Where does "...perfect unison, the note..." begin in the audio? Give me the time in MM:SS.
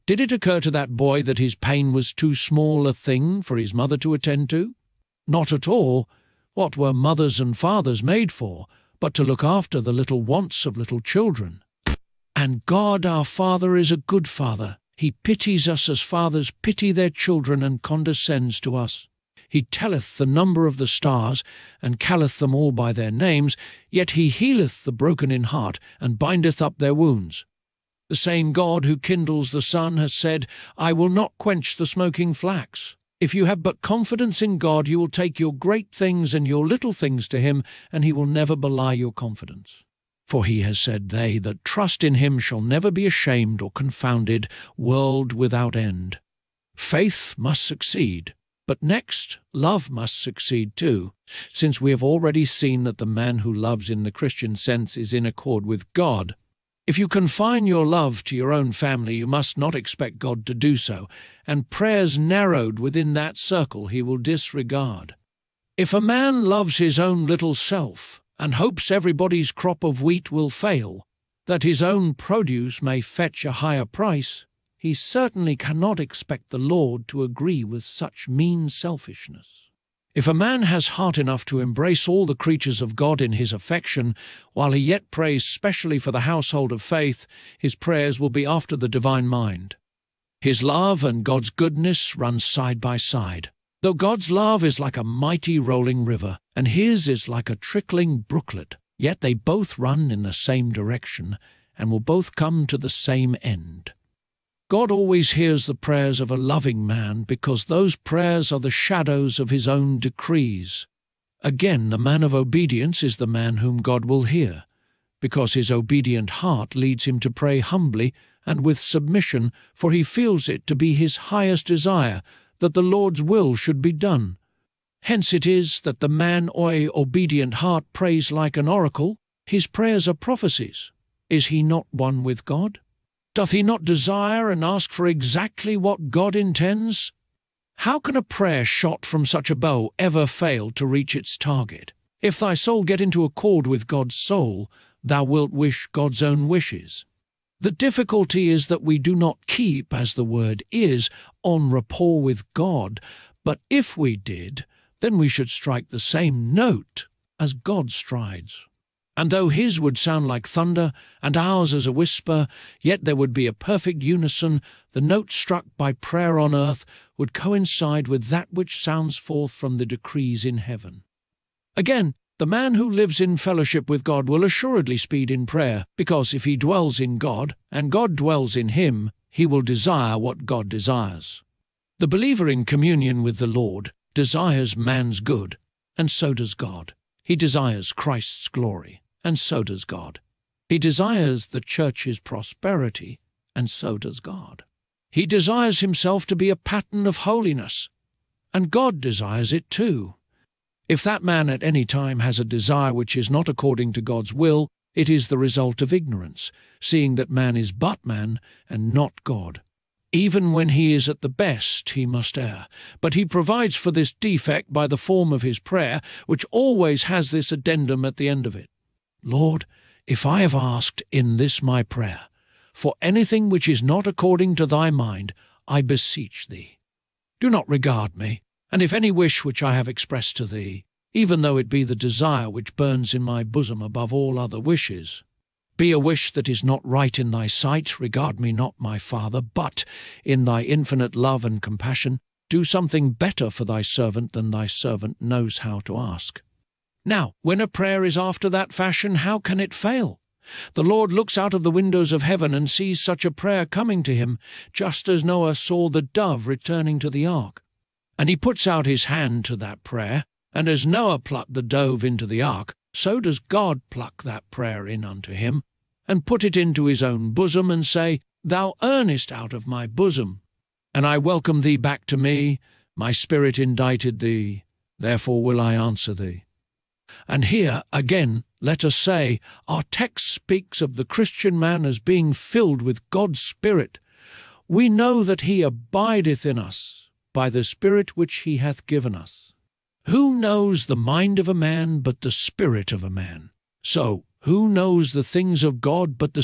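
02:43.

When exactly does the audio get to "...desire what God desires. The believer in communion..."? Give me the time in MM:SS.
02:59.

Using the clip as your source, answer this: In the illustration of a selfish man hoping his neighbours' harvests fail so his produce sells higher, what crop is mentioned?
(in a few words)
Wheat.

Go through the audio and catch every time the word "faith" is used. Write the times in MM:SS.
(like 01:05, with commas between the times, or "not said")
00:46, 01:26.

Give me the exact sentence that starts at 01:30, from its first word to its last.
His love and God's goodness run side by side.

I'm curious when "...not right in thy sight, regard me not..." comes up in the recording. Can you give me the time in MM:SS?
03:56.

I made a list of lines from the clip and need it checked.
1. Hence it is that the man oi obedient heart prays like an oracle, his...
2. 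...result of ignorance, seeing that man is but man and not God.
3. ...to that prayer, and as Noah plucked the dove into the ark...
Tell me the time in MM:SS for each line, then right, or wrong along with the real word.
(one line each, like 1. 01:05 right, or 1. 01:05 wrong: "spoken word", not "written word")
1. 02:05 right
2. 03:25 right
3. 04:19 right.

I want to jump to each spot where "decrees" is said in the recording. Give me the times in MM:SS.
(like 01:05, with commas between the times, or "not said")
01:49, 02:49.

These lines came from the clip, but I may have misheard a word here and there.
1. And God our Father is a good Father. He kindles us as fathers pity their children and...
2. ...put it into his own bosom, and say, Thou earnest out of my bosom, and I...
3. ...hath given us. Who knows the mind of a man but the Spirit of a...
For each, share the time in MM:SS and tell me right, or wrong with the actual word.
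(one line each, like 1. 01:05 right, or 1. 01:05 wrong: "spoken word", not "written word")
1. 00:12 wrong: "pities", not "kindles"
2. 04:26 right
3. 04:48 right.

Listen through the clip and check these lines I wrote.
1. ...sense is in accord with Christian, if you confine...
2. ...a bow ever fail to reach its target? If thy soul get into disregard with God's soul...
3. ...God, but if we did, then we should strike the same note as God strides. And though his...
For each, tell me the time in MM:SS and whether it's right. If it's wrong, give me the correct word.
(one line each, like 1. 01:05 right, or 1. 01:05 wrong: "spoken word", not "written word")
1. 00:54 wrong: "God", not "Christian"
2. 02:19 wrong: "accord", not "disregard"
3. 02:32 right.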